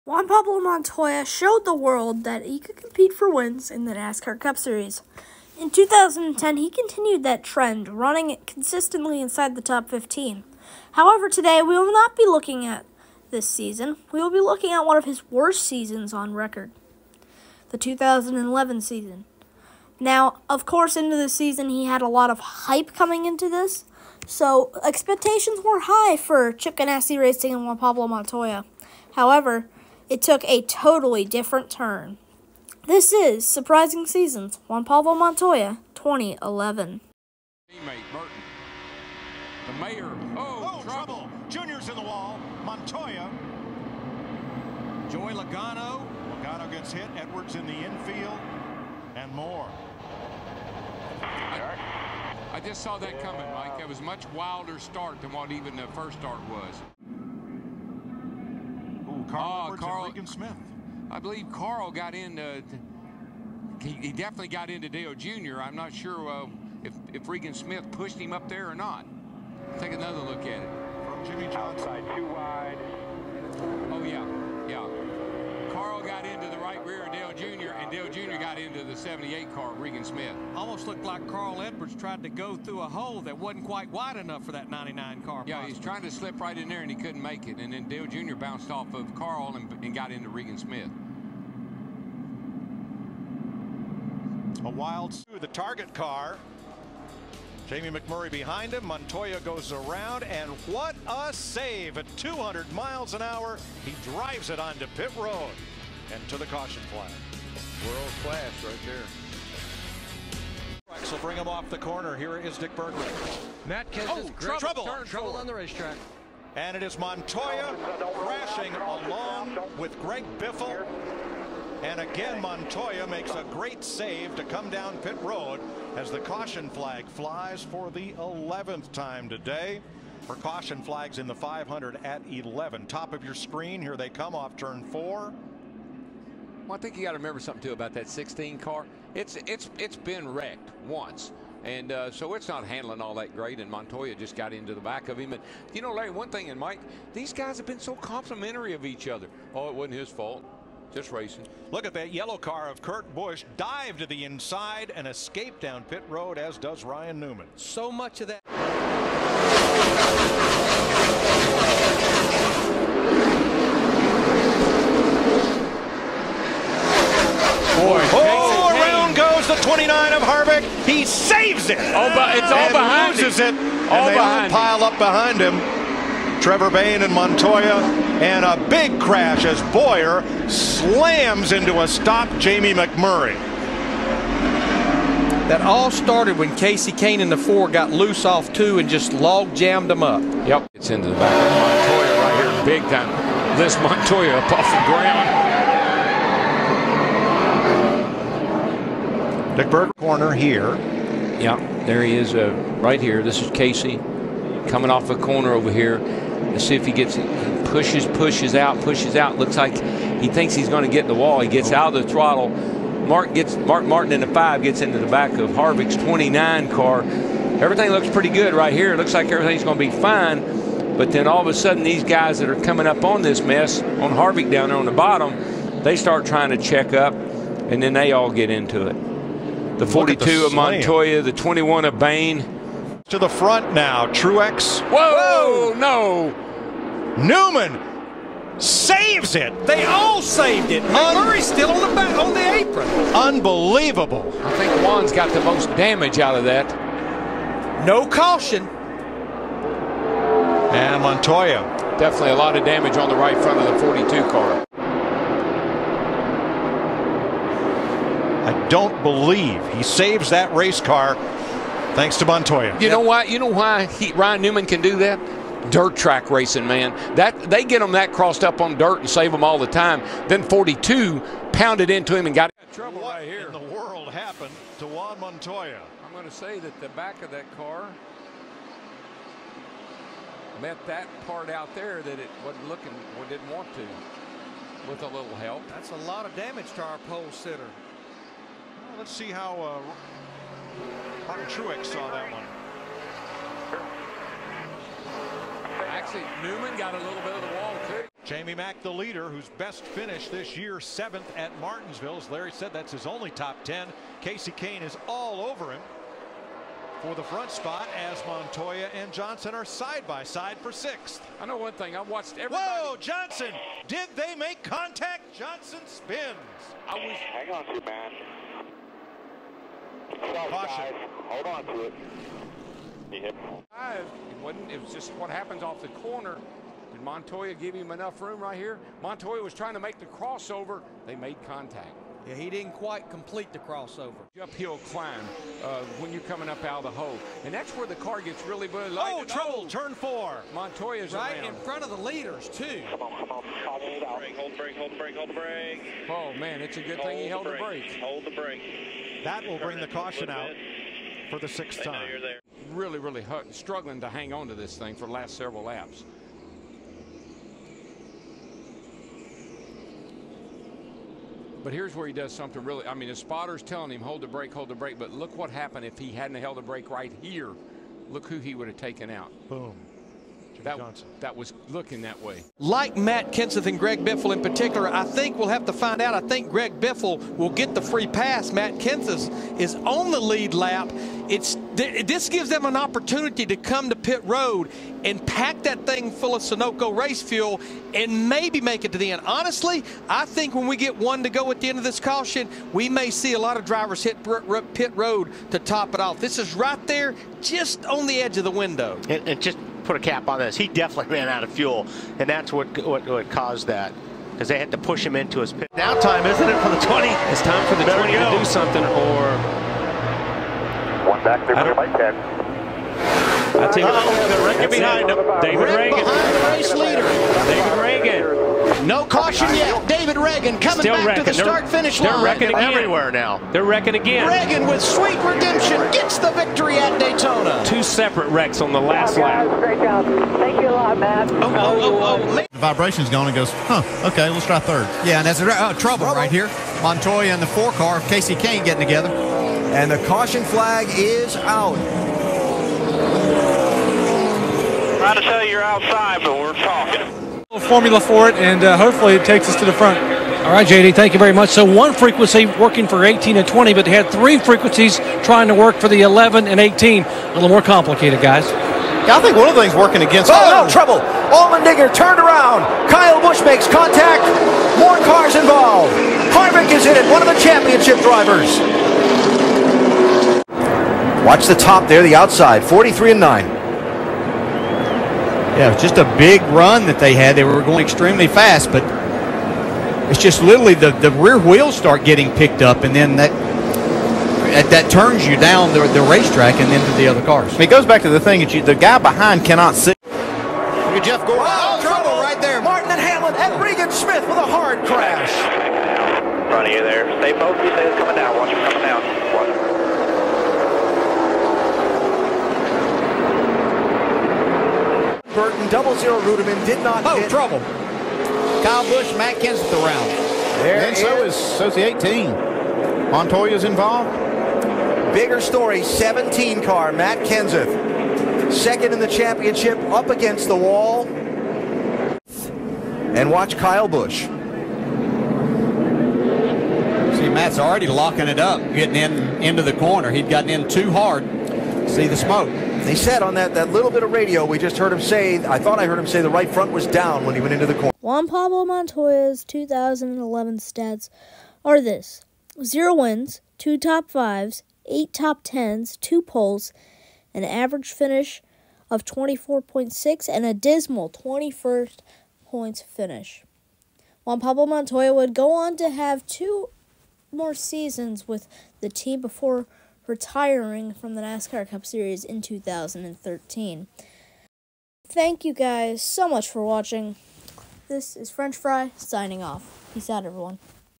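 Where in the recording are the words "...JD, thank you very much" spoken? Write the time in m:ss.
7:30.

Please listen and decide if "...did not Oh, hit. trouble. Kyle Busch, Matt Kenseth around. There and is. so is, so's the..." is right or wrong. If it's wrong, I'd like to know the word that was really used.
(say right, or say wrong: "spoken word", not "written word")
right.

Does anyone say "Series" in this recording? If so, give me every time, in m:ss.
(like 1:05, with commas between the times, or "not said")
0:04, 9:21.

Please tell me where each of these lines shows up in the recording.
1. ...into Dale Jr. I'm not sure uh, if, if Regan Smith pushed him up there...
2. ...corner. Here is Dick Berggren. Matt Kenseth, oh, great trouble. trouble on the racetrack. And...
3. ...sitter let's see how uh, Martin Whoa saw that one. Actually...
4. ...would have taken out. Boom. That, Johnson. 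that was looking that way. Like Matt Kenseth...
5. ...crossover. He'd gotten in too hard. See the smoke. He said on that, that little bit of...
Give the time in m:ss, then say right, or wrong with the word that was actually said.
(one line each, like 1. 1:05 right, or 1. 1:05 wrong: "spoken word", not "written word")
1. 1:04 right
2. 1:51 right
3. 4:47 wrong: "Truex", not "Whoa"
4. 6:08 right
5. 8:49 wrong: "corner", not "crossover".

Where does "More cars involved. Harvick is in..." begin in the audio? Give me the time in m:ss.
7:44.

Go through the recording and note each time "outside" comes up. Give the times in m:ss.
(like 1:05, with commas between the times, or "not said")
1:11, 7:25, 7:52.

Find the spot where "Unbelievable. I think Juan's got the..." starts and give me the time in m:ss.
4:03.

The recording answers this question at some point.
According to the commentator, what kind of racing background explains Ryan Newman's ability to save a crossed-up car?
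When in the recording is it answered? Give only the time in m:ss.
4:25.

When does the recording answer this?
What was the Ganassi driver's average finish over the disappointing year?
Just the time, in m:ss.
9:09.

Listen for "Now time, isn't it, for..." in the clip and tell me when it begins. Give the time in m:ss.
6:45.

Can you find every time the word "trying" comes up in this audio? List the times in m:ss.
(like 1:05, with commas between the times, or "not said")
1:25, 3:46, 5:29, 7:24, 7:35.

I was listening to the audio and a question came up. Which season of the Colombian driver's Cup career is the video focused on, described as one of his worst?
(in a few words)
2011.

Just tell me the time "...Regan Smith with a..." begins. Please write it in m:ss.
8:13.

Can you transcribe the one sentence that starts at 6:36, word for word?
This is right there, just on the edge of the window.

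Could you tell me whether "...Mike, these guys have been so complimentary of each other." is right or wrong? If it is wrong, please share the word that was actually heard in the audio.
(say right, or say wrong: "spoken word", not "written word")
right.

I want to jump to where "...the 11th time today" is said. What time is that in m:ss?
2:07.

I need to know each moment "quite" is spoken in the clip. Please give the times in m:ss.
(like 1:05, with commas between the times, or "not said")
1:23, 5:32.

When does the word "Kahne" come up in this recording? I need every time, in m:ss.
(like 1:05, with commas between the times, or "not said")
3:06, 5:04, 7:18.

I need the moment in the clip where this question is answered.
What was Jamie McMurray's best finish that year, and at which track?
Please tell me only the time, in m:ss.
5:00.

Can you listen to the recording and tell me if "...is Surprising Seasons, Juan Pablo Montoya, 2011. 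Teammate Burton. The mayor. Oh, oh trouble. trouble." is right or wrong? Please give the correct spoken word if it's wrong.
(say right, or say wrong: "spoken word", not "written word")
right.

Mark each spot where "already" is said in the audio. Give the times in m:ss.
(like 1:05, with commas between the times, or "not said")
8:47.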